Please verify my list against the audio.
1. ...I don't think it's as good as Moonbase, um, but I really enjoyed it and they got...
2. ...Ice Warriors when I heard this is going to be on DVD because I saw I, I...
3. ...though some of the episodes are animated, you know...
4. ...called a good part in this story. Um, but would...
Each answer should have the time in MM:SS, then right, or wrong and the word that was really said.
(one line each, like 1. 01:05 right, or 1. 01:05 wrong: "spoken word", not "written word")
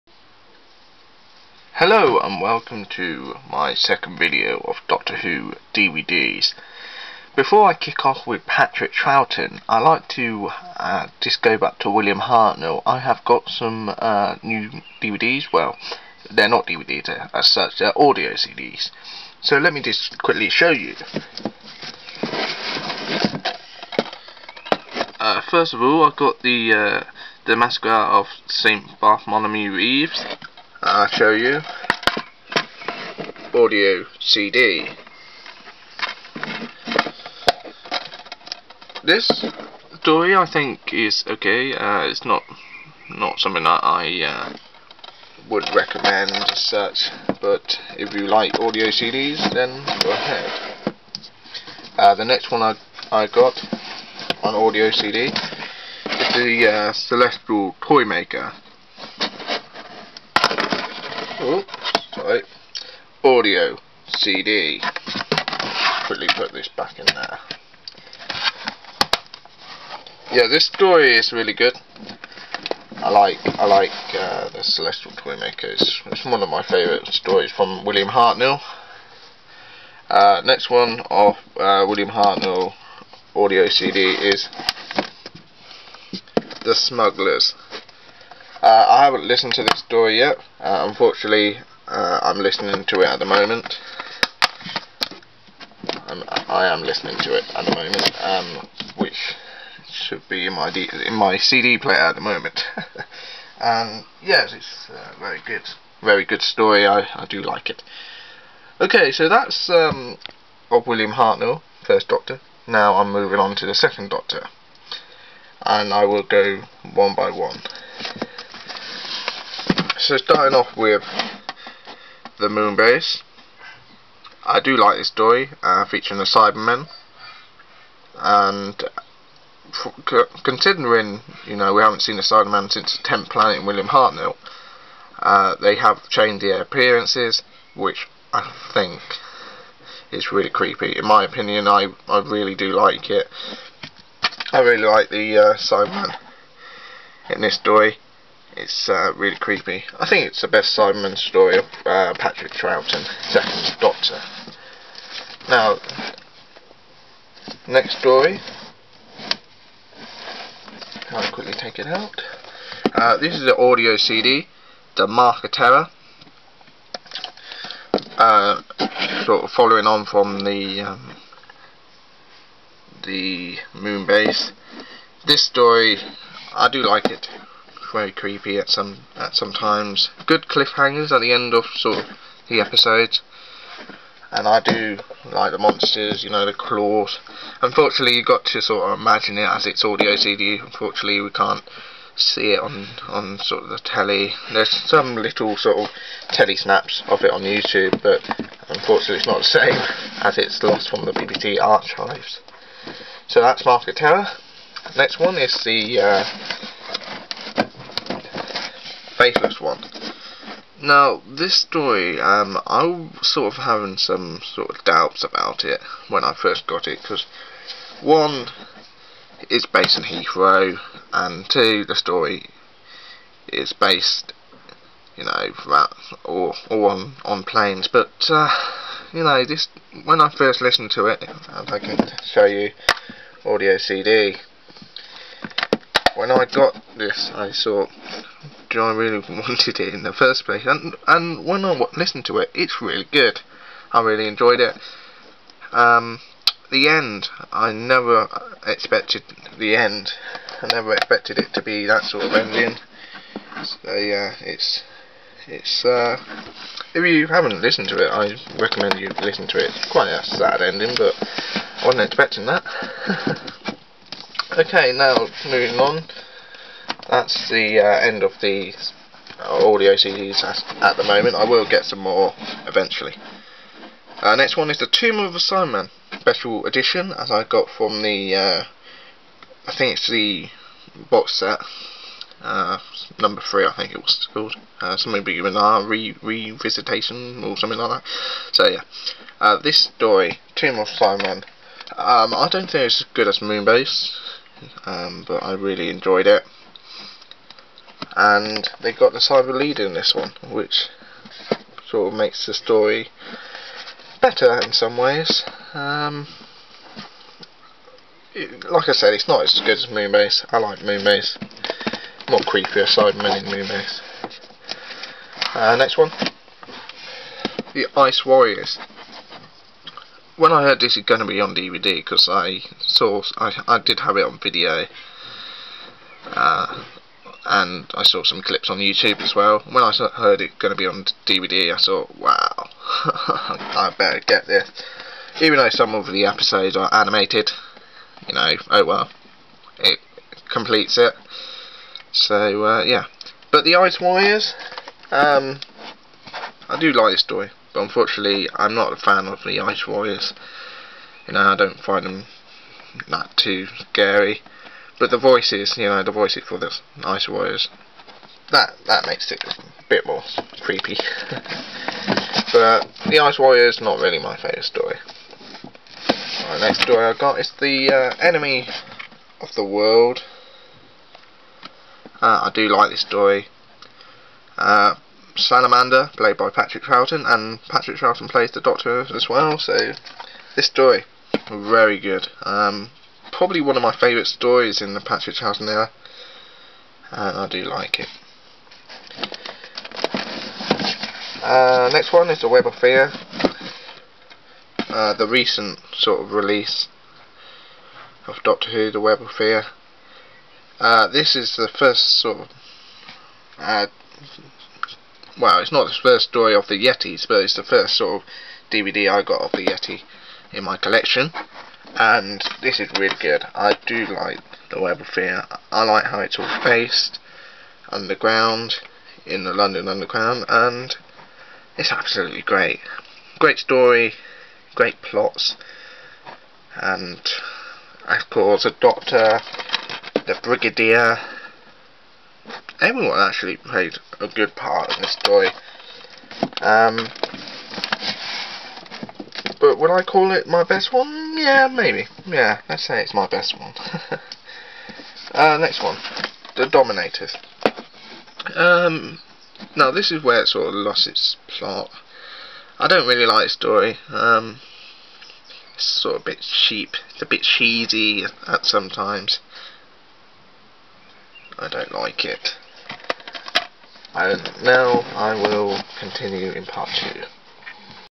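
1. 04:52 right
2. 05:17 right
3. 05:35 right
4. 07:13 wrong: "played", not "called".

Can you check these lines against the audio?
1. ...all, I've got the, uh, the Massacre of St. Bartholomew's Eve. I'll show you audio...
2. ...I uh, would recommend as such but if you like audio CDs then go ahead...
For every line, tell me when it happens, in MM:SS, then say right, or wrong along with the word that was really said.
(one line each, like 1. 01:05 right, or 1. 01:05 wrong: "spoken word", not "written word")
1. 00:25 right
2. 00:43 right.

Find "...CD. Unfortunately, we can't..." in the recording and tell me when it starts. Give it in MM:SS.
03:10.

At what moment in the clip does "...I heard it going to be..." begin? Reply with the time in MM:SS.
05:29.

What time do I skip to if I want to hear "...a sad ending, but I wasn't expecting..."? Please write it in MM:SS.
04:20.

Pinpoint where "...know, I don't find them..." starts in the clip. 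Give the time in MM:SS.
05:51.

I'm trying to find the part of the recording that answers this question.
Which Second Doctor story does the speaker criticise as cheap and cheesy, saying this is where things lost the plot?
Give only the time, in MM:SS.
07:26.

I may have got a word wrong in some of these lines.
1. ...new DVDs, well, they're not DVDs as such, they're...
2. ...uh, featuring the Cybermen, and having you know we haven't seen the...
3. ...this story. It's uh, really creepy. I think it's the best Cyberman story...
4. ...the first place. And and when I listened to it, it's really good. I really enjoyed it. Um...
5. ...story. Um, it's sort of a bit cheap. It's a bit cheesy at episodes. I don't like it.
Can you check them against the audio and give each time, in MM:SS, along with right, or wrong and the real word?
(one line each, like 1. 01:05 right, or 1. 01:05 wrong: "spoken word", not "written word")
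1. 00:14 right
2. 02:05 wrong: "considering", not "having"
3. 02:27 right
4. 04:00 right
5. 07:33 wrong: "sometimes", not "episodes".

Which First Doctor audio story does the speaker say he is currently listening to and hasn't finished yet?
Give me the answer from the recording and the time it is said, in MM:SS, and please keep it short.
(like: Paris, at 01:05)
The Smugglers, at 01:26.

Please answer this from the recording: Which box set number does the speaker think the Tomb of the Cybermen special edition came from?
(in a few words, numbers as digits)
3.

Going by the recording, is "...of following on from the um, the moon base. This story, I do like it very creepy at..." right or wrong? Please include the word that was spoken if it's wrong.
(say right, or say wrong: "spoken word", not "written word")
right.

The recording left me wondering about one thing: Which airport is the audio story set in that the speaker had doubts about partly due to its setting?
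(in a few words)
Heathrow.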